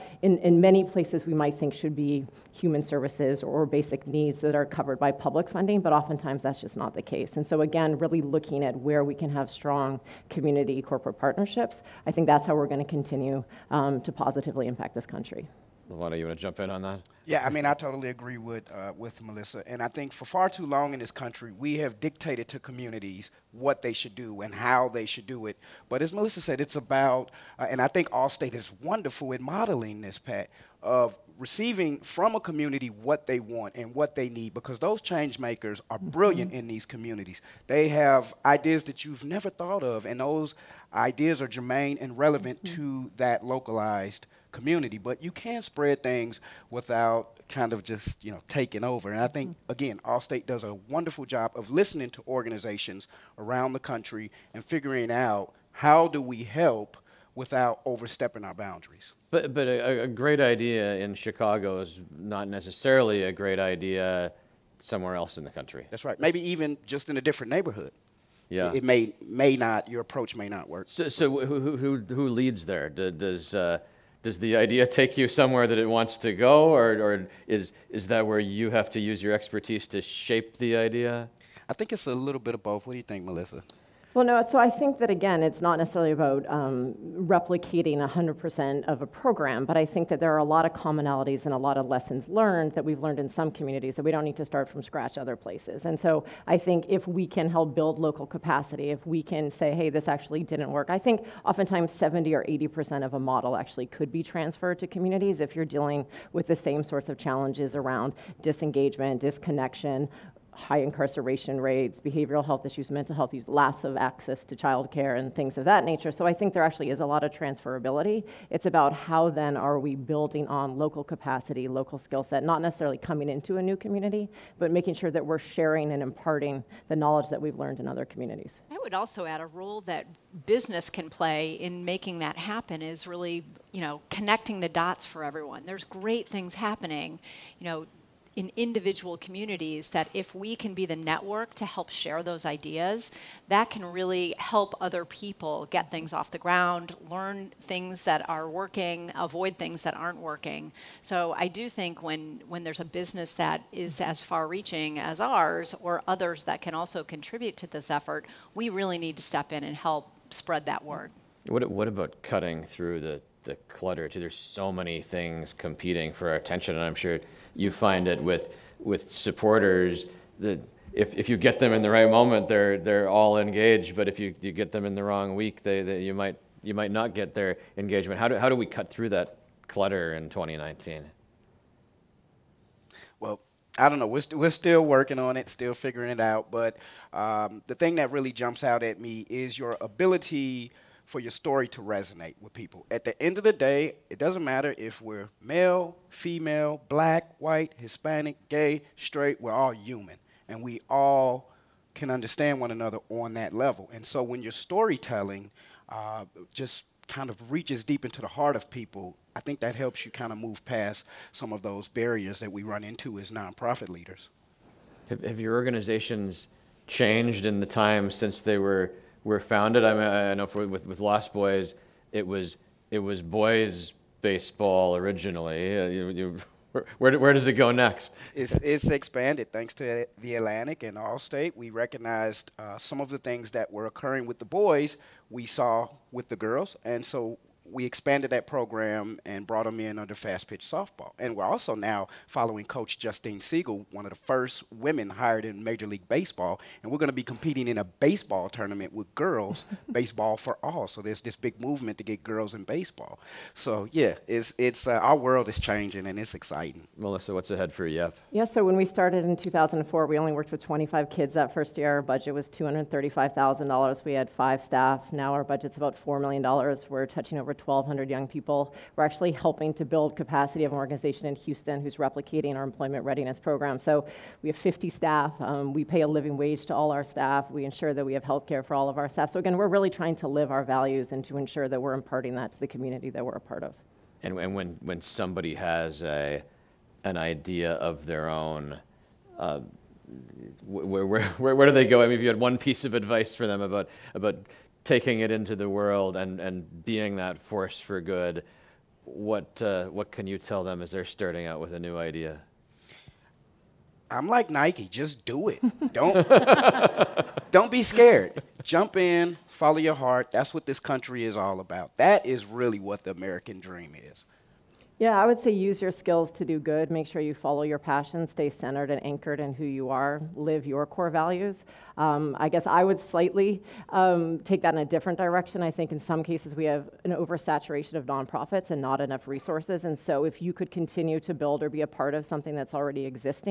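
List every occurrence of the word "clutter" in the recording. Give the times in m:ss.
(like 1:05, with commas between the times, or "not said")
2:43, 2:59.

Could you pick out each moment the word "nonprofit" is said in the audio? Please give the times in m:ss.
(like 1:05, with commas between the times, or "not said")
3:33, 5:28.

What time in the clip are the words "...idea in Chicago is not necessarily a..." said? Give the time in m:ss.
1:00.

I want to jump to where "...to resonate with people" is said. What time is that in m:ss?
3:11.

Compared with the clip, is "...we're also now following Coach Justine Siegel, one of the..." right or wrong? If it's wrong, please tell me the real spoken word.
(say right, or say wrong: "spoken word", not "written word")
right.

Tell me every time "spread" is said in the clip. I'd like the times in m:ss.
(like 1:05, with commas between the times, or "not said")
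0:45, 2:40.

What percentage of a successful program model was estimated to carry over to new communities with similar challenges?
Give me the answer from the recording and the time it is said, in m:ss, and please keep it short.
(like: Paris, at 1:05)
70 or 80%, at 1:41.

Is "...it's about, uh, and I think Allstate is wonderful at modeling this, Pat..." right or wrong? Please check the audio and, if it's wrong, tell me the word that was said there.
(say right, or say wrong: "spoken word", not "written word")
right.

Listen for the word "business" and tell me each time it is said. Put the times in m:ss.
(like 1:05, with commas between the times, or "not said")
2:10, 2:32.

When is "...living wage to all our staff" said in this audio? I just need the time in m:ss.
4:36.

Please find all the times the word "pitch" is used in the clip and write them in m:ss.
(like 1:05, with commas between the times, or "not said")
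4:00.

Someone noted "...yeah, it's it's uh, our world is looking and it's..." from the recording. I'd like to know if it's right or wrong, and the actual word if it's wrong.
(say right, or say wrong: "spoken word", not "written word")
wrong: "changing", not "looking".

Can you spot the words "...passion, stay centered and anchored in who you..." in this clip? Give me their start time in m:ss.
5:17.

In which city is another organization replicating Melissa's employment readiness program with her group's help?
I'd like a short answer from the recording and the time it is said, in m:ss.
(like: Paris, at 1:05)
Houston, at 4:31.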